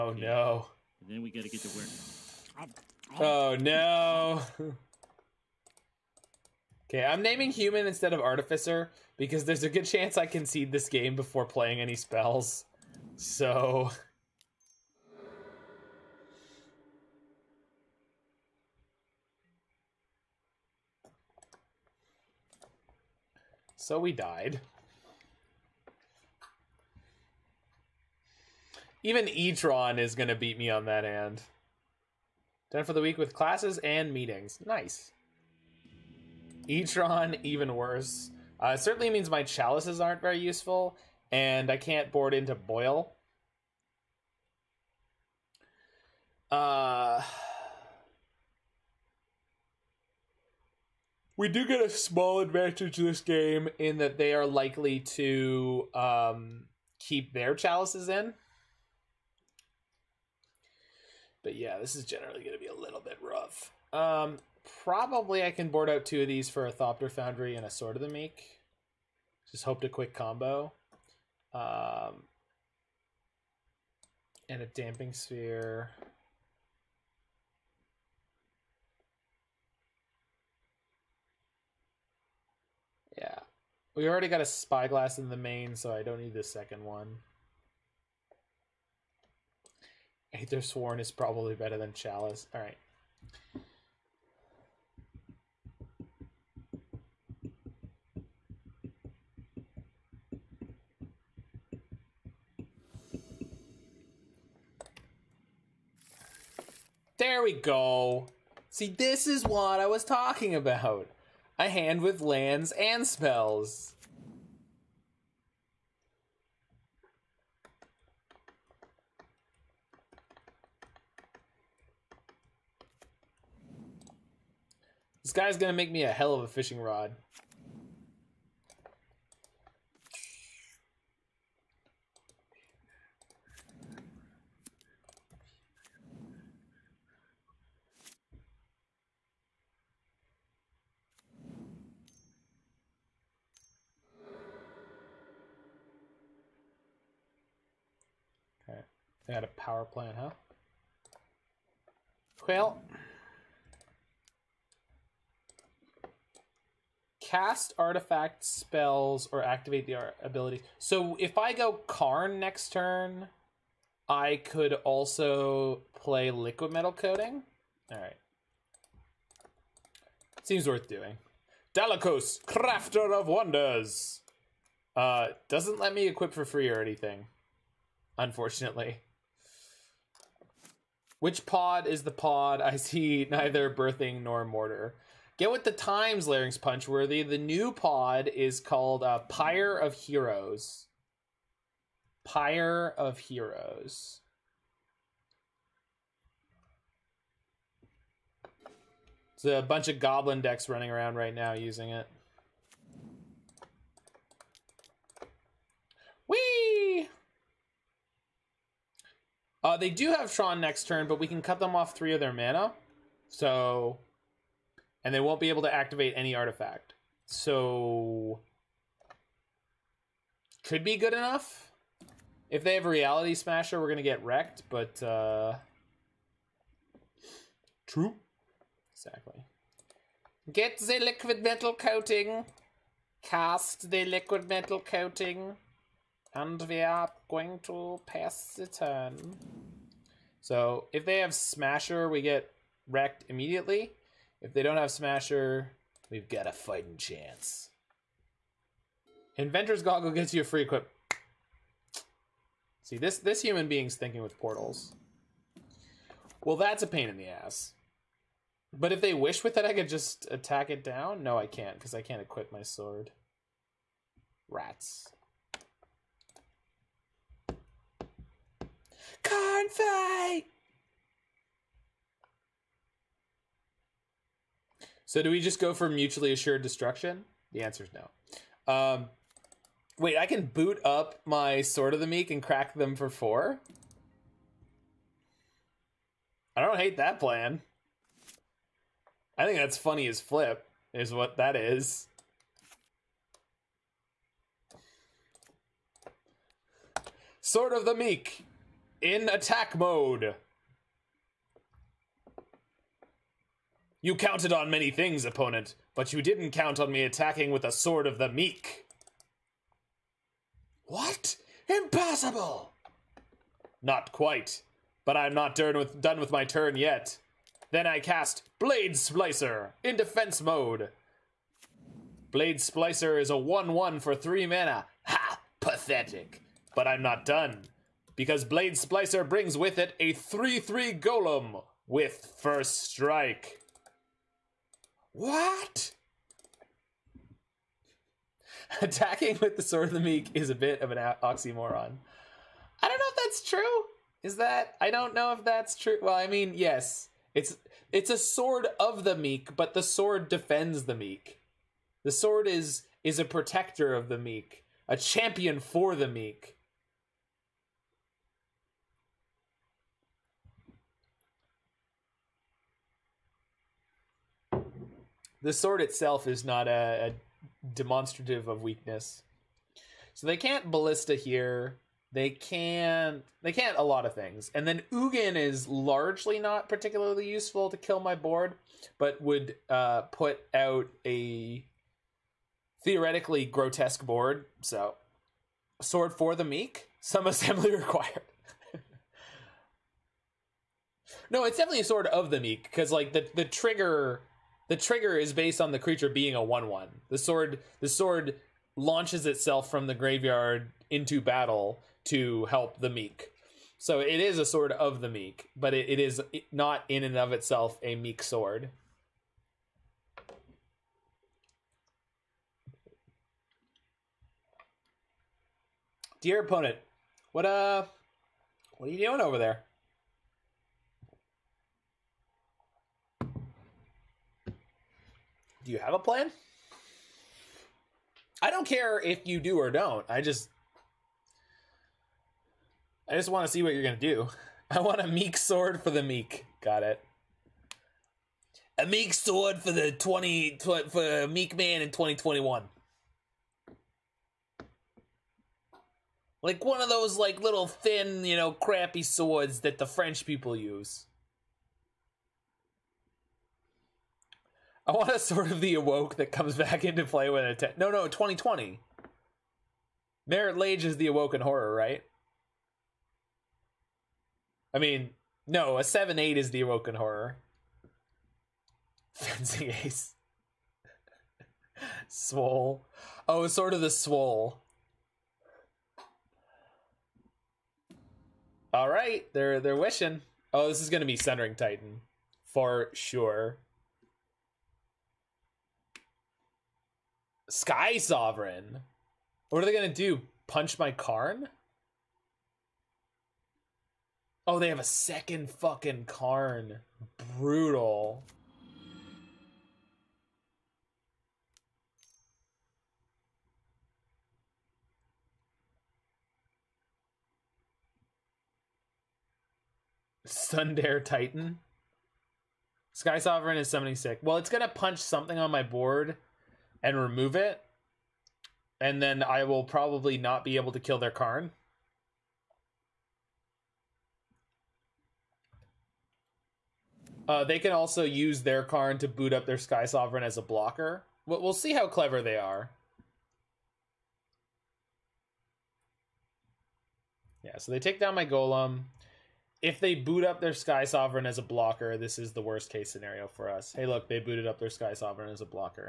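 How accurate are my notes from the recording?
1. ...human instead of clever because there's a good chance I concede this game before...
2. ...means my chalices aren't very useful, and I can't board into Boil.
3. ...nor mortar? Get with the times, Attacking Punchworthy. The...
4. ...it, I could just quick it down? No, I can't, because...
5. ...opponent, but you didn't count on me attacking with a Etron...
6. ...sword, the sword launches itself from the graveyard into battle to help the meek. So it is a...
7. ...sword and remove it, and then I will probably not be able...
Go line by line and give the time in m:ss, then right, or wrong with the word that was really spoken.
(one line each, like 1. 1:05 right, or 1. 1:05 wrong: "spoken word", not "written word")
1. 0:07 wrong: "artificer", not "clever"
2. 0:39 right
3. 3:04 wrong: "Larynx", not "Attacking"
4. 4:19 wrong: "attack", not "quick"
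5. 5:05 wrong: "Sword", not "Etron"
6. 6:37 right
7. 8:35 wrong: "board", not "sword".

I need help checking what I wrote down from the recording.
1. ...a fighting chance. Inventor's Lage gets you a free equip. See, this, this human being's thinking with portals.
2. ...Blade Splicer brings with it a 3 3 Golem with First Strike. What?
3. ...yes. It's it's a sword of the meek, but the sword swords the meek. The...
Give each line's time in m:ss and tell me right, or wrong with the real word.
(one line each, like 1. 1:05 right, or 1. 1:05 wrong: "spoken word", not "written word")
1. 4:06 wrong: "Goggle", not "Lage"
2. 5:28 right
3. 5:46 wrong: "defends", not "swords".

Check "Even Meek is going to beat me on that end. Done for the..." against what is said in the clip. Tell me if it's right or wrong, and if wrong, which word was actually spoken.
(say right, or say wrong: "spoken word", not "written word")
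wrong: "Etron", not "Meek".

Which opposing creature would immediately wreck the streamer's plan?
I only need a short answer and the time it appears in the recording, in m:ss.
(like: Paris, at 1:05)
Reality Smasher, at 3:42.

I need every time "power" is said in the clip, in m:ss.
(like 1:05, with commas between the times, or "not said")
2:29.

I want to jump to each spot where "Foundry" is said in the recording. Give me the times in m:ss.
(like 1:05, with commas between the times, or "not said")
1:07.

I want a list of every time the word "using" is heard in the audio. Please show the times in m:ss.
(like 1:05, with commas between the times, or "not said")
3:21.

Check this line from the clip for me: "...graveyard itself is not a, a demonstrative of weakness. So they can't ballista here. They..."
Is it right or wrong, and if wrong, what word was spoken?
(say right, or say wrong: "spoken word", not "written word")
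wrong: "sword", not "graveyard".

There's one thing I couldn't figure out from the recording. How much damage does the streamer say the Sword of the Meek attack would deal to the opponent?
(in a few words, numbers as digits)
4.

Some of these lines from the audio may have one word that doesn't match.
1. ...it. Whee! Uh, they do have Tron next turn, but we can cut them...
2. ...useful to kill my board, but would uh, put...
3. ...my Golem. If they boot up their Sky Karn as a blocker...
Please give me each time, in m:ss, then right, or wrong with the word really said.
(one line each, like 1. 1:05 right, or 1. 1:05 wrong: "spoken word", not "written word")
1. 3:21 right
2. 6:17 right
3. 8:58 wrong: "Sovereign", not "Karn".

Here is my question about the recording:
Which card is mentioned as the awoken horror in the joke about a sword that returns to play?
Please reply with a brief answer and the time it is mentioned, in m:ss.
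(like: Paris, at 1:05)
Marit Lage, at 7:40.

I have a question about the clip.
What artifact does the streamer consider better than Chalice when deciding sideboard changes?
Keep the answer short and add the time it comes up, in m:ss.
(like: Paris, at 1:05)
Aethersworn, at 1:30.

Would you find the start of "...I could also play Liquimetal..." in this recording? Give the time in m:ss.
2:44.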